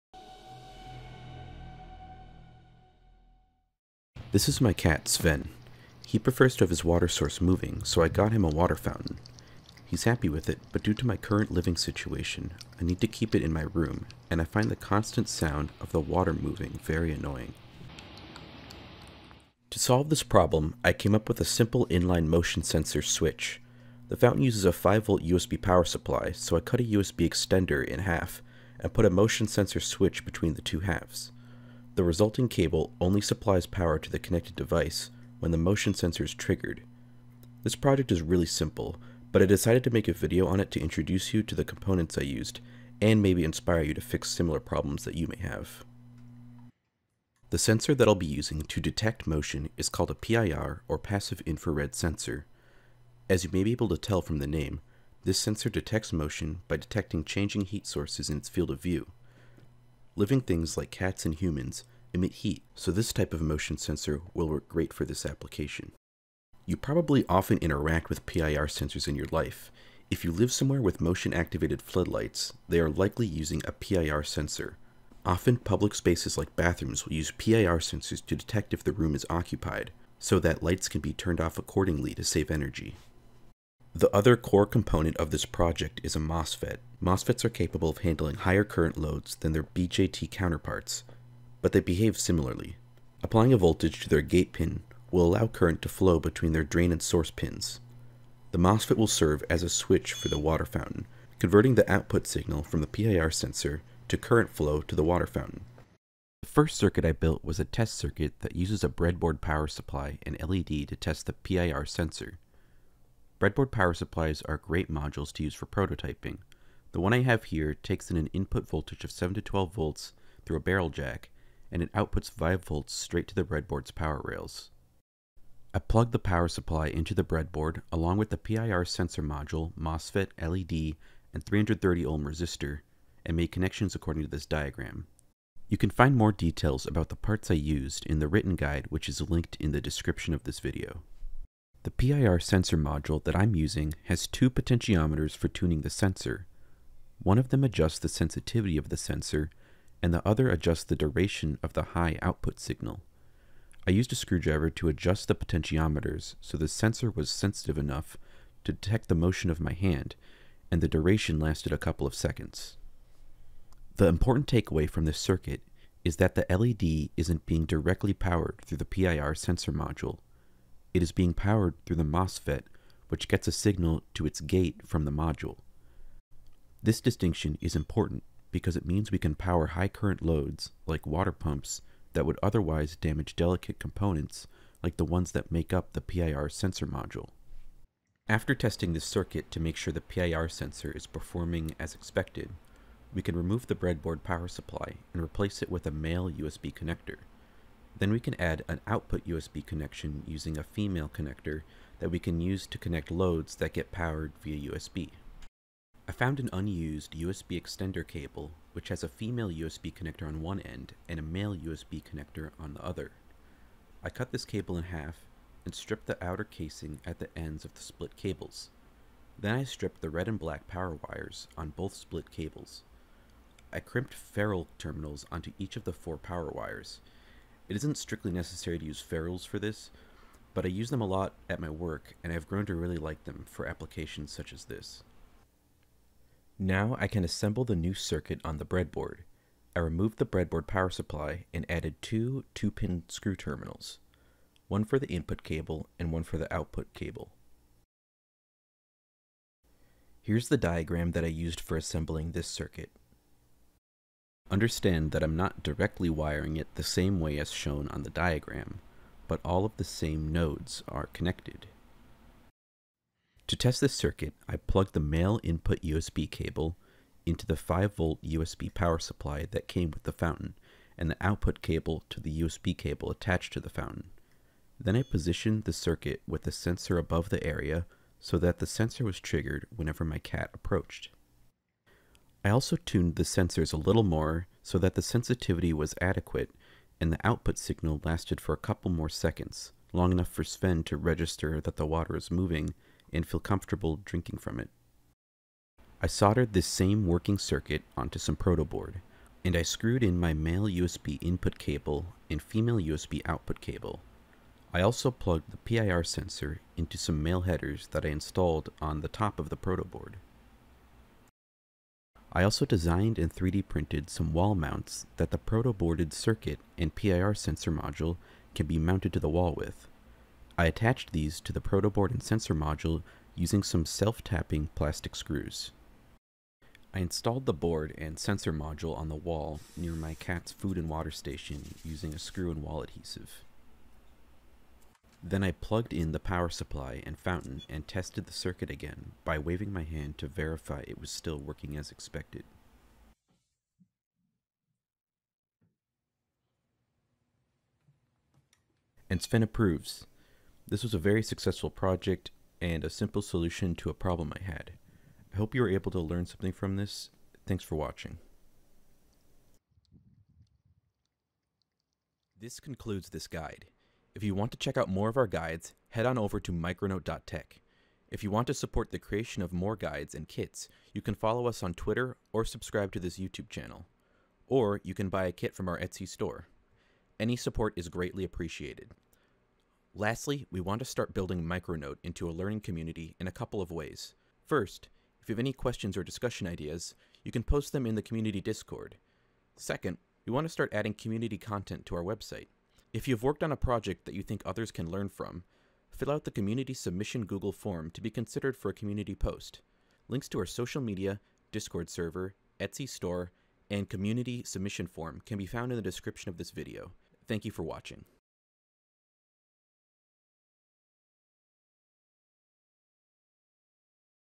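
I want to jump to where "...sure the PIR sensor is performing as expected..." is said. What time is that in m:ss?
3:09.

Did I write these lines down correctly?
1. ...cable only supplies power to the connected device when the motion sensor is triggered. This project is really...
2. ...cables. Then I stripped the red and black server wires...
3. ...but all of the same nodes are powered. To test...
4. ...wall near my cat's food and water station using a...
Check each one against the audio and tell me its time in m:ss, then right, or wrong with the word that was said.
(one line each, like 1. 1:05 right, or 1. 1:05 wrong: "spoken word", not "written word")
1. 0:32 right
2. 3:38 wrong: "power", not "server"
3. 4:19 wrong: "connected", not "powered"
4. 5:29 right.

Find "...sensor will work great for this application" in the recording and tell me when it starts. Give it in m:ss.
1:03.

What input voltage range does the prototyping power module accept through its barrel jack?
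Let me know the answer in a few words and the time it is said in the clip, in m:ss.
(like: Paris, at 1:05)
7 to 12 volts, at 1:59.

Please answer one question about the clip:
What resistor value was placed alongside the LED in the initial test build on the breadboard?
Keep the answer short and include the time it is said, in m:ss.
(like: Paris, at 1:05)
330 ohm, at 2:11.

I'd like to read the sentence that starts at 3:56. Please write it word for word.
Now I can assemble the new circuit on the breadboard.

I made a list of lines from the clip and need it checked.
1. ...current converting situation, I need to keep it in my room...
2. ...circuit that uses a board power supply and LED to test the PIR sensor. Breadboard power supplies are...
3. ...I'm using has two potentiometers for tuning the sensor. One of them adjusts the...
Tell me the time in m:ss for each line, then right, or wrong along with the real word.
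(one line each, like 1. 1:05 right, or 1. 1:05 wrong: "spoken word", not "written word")
1. 0:11 wrong: "living", not "converting"
2. 1:47 wrong: "breadboard", not "board"
3. 2:23 right.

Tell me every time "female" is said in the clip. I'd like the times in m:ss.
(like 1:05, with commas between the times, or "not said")
3:20, 3:29, 5:02.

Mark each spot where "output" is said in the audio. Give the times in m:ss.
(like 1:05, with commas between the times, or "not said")
1:41, 2:01, 2:32, 3:18, 4:06, 4:31, 4:47, 5:03.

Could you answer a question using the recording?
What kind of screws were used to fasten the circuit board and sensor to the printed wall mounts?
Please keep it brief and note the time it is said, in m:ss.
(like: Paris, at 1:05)
Self-tapping plastic screws, at 5:23.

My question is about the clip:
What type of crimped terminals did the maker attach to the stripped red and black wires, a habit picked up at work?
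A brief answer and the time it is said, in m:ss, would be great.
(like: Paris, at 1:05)
Ferrule terminals, at 3:44.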